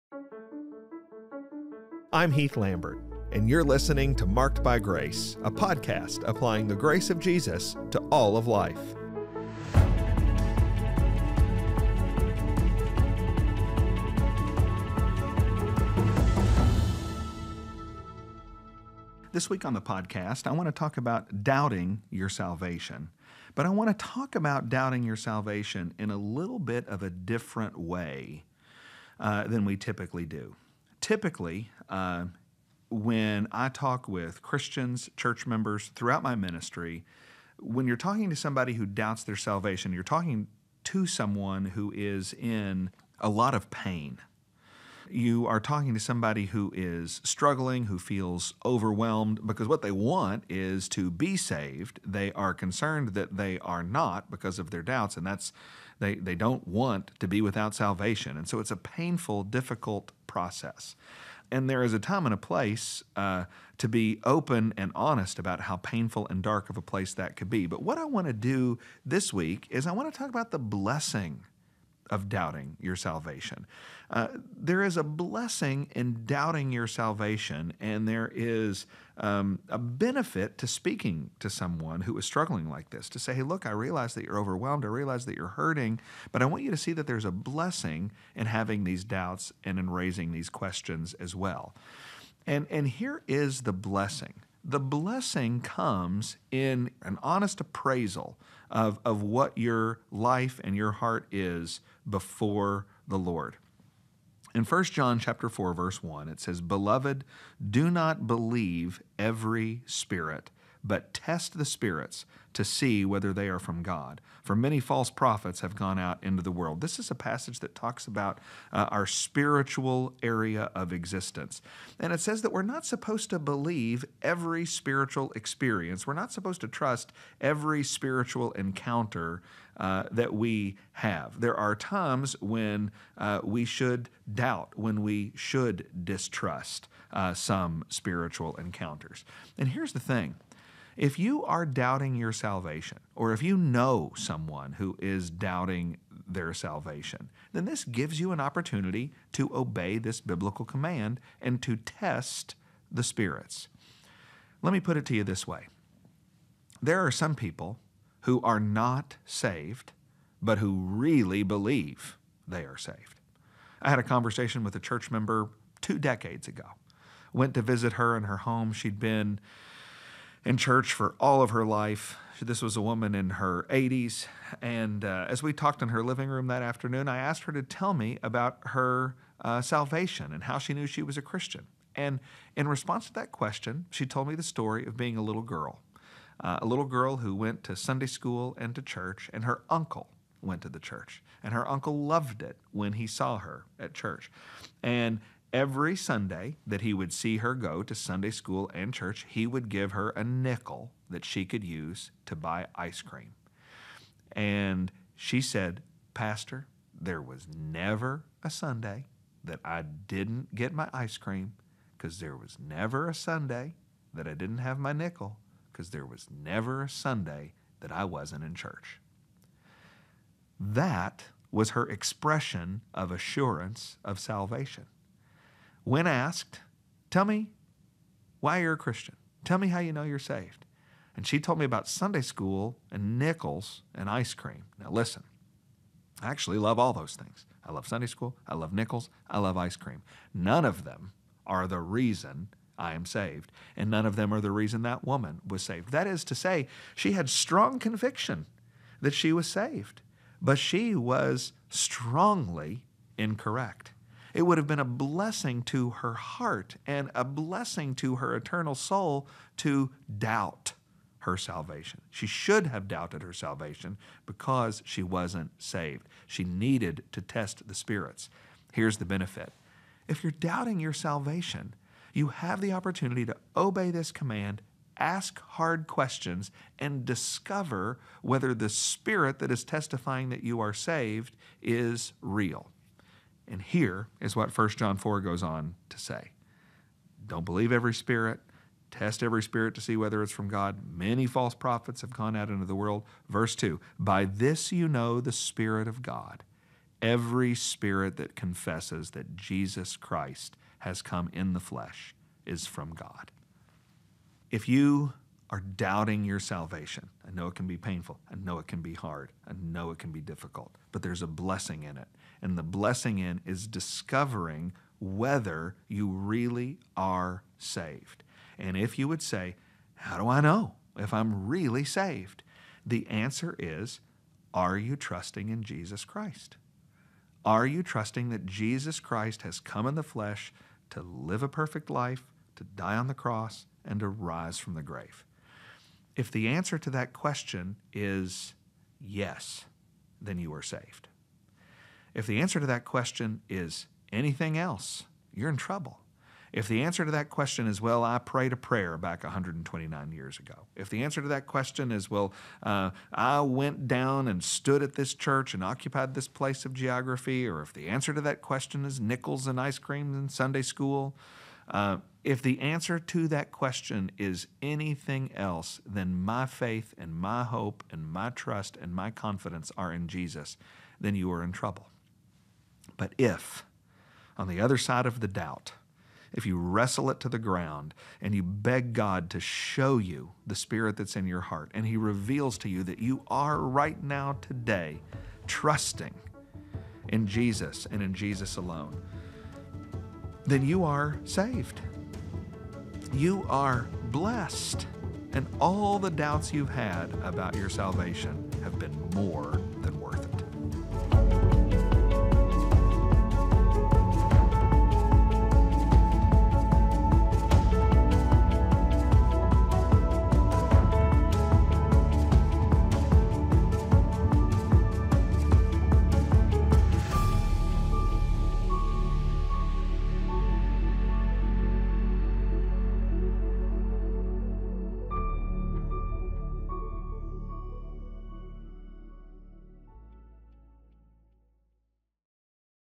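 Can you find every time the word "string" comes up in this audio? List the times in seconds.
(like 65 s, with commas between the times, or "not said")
not said.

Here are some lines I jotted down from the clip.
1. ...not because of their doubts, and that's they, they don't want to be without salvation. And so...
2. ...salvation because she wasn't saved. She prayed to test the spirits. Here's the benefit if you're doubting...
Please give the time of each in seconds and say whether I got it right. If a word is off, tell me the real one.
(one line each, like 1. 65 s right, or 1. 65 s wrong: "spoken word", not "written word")
1. 53 s right
2. 263 s wrong: "needed", not "prayed".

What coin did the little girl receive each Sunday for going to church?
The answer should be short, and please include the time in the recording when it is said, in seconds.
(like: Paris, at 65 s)
A nickel, at 200 s.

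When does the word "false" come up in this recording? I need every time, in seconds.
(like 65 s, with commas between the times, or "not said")
114 s, 291 s.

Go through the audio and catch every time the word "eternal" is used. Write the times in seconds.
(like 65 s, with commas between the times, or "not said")
258 s.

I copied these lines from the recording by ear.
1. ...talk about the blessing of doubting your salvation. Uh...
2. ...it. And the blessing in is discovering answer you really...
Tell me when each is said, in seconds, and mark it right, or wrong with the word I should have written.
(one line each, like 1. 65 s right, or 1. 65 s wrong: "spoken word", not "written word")
1. 70 s right
2. 311 s wrong: "whether", not "answer".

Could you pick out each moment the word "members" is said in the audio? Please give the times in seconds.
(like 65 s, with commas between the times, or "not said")
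35 s, 165 s.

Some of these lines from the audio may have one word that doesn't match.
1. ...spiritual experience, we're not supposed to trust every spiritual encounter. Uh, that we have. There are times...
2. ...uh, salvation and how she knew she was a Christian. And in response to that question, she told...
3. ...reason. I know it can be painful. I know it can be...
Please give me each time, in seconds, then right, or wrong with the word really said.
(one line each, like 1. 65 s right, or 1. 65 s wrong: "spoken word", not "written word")
1. 124 s right
2. 179 s right
3. 306 s wrong: "salvation", not "reason".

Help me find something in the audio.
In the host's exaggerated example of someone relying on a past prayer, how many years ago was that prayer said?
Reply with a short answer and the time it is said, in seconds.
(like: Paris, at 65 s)
129 years, at 349 s.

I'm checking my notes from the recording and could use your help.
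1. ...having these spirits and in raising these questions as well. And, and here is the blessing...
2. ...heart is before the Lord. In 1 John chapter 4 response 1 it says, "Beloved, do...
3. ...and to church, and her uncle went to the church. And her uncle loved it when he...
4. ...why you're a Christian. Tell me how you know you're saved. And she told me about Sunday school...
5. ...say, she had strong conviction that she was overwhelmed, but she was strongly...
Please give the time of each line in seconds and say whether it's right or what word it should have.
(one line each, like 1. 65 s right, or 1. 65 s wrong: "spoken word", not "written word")
1. 88 s wrong: "doubts", not "spirits"
2. 100 s wrong: "verse", not "response"
3. 188 s right
4. 228 s right
5. 246 s wrong: "saved", not "overwhelmed".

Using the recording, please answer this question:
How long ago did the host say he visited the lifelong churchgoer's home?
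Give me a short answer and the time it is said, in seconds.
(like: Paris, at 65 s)
Two decades ago, at 165 s.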